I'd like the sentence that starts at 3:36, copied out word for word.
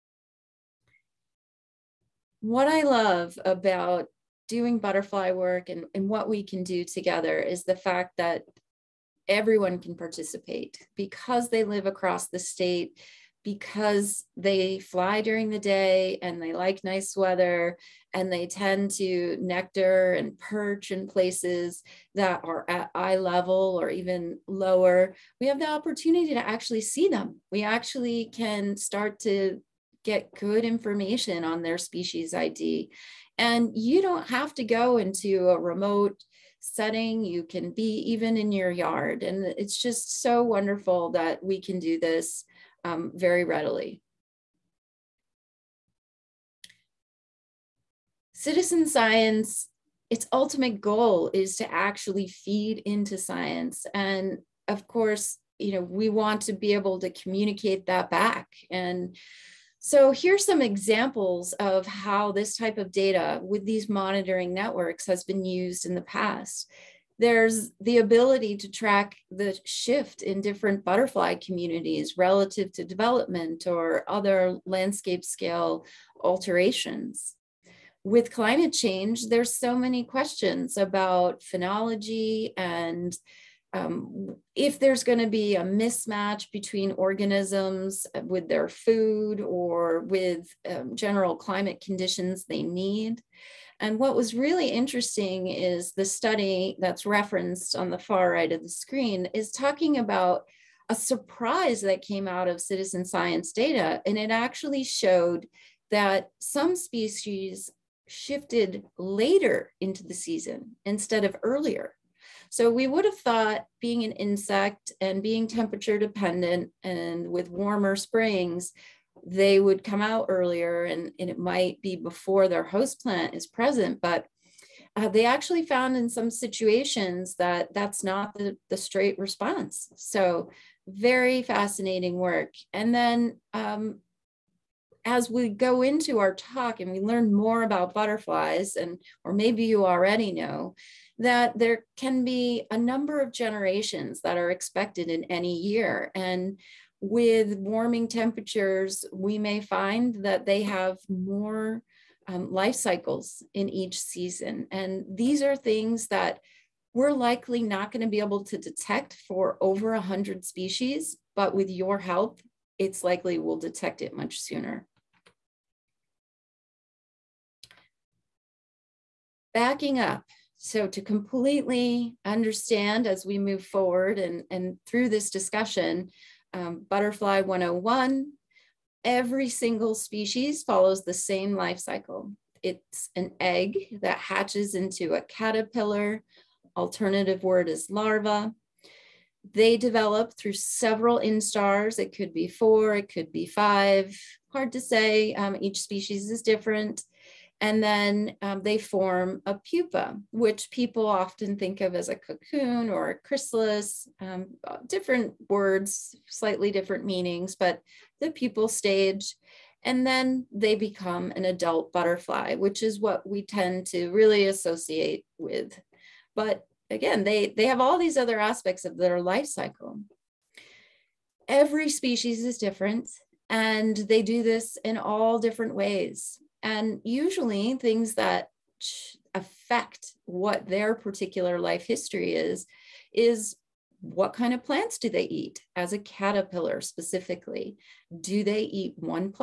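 But again, they, they have all these other aspects of their life cycle.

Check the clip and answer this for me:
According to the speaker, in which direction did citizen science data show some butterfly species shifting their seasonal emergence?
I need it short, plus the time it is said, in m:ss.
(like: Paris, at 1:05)
later, at 1:48.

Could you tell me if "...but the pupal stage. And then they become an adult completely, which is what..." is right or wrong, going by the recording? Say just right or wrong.
wrong.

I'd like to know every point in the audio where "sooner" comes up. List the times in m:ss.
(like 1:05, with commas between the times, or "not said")
2:44.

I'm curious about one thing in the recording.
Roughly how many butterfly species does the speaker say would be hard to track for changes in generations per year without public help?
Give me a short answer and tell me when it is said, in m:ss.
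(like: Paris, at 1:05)
100, at 2:39.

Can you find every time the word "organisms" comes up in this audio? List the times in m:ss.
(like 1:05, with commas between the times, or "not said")
1:26.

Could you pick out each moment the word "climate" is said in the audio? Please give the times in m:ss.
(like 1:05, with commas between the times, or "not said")
1:18, 1:31.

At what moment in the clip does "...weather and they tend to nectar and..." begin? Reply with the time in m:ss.
0:17.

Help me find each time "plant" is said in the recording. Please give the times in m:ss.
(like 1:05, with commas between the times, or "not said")
2:03, 3:54.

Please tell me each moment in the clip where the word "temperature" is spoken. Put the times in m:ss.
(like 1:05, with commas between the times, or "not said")
1:55, 2:28.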